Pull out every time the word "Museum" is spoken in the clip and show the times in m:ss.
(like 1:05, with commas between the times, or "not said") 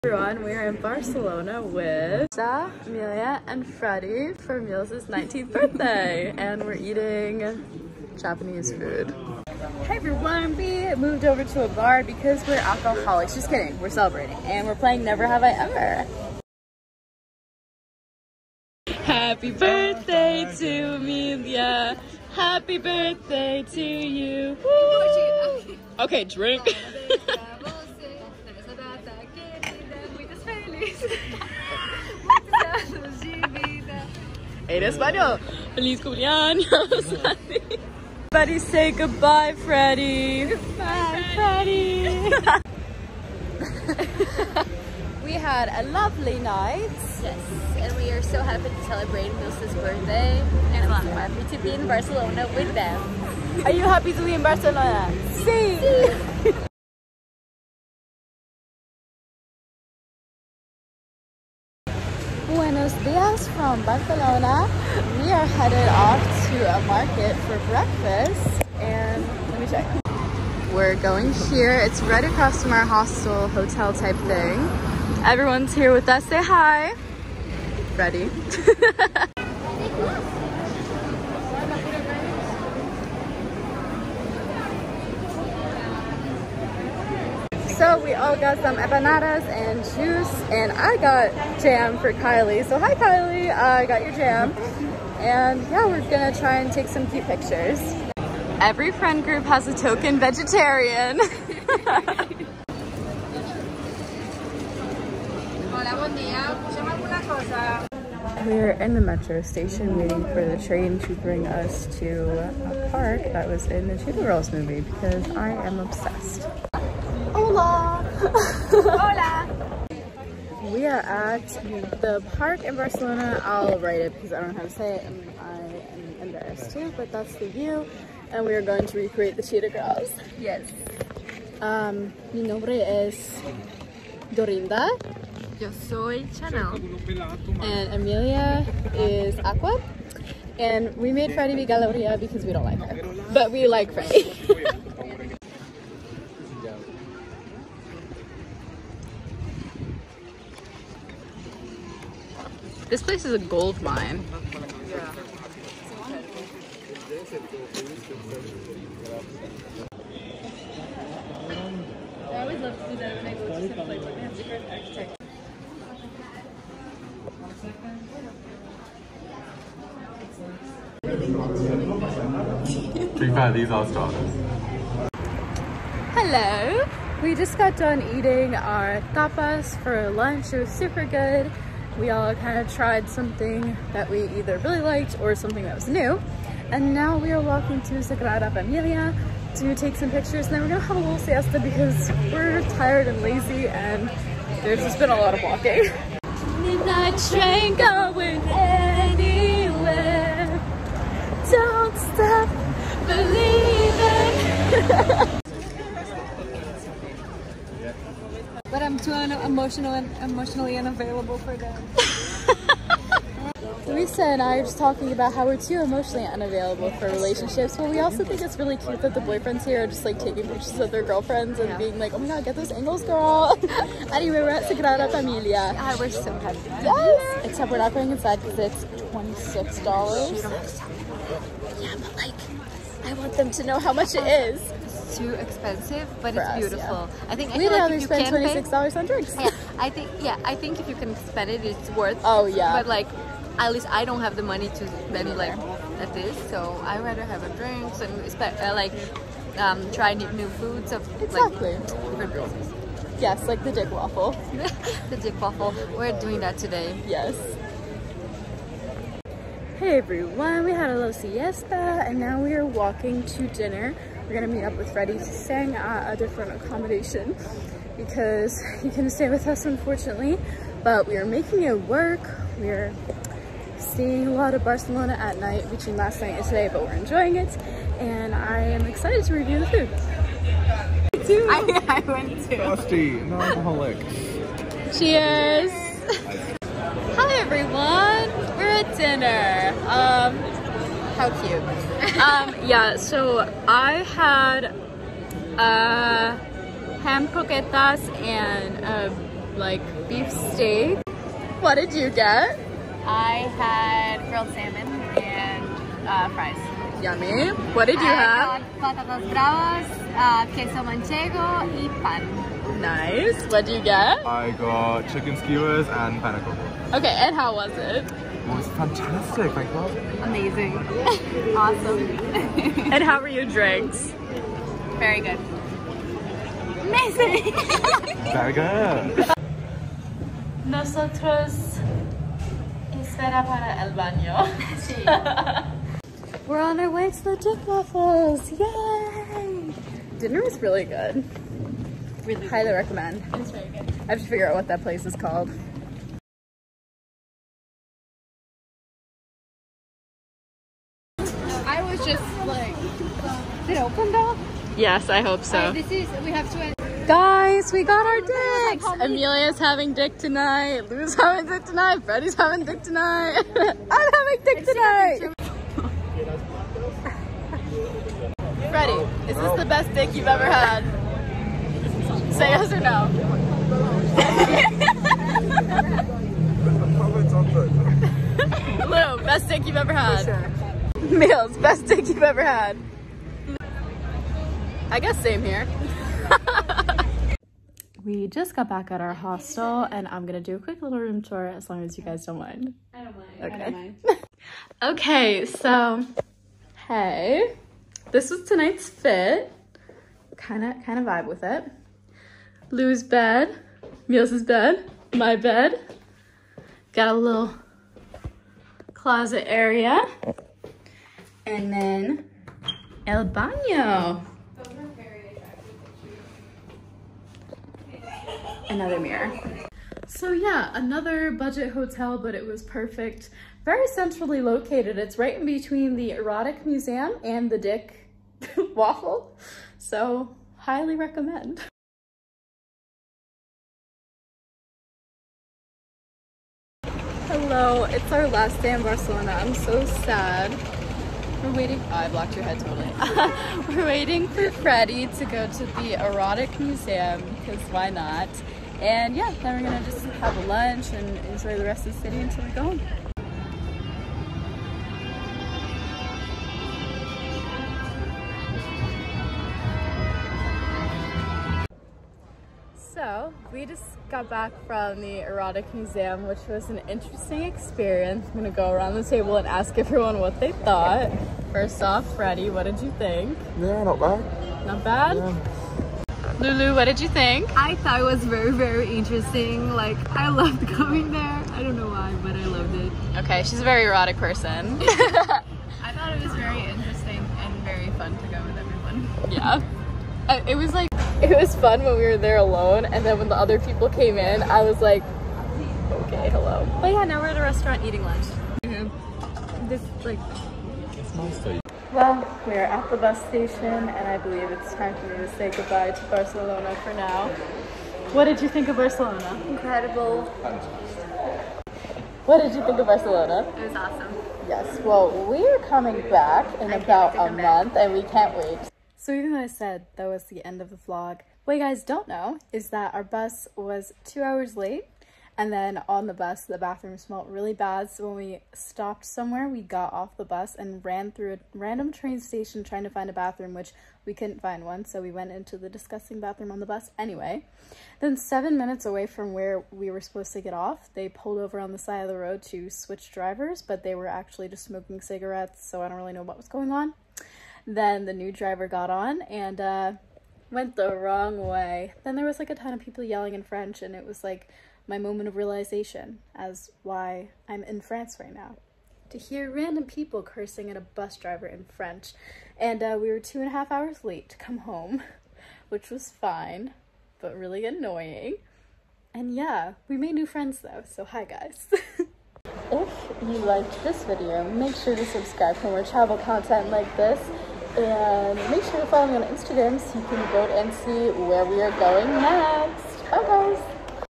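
7:06, 7:26, 7:45.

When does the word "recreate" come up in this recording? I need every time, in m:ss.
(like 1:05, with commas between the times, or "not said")
2:08.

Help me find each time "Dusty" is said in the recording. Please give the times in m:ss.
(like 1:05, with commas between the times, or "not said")
4:42.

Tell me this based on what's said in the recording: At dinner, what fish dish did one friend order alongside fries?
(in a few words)
grilled salmon.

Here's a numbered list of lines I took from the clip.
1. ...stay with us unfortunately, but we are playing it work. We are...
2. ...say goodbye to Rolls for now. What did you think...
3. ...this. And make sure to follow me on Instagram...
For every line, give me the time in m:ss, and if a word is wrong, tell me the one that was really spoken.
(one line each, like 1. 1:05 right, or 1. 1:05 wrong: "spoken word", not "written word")
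1. 4:29 wrong: "making", not "playing"
2. 8:25 wrong: "Barcelona", not "Rolls"
3. 9:36 right.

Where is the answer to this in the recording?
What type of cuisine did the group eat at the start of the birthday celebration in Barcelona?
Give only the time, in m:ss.
0:08.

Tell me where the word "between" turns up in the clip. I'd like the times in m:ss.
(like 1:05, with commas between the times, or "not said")
4:35, 7:05.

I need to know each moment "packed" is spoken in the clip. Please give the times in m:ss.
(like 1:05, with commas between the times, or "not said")
not said.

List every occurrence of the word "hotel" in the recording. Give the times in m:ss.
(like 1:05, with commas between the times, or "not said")
1:13, 7:01.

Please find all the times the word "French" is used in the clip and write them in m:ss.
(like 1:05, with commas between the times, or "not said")
9:13, 9:21.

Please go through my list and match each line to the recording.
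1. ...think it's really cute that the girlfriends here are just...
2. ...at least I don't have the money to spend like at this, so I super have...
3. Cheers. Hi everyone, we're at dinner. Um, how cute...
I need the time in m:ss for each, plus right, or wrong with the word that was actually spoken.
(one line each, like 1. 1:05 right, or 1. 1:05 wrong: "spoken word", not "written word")
1. 3:38 wrong: "boyfriends", not "girlfriends"
2. 4:03 wrong: "rather", not "super"
3. 4:44 right.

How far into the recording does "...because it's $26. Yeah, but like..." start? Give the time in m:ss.
3:48.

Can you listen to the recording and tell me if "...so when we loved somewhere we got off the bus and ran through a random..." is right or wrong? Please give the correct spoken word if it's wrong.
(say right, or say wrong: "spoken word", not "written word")
wrong: "stopped", not "loved".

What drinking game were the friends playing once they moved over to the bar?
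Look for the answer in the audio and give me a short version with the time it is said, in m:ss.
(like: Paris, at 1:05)
Never Have I Ever, at 0:15.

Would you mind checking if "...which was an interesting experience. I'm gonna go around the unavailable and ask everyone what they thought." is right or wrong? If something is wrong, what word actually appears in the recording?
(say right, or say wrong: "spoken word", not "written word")
wrong: "table", not "unavailable".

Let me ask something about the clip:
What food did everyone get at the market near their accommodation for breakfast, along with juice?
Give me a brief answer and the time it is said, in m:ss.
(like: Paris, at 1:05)
empanadas, at 1:28.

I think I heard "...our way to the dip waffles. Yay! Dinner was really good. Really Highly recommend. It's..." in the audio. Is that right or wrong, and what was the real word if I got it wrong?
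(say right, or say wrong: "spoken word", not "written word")
right.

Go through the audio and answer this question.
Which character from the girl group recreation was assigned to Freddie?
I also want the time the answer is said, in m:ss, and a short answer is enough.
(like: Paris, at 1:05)
Galleria, at 2:21.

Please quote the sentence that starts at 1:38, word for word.
Every friend group has a token vegetarian.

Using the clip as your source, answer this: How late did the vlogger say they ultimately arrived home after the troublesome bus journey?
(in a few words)
two and a half hours.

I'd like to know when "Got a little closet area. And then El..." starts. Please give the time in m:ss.
6:46.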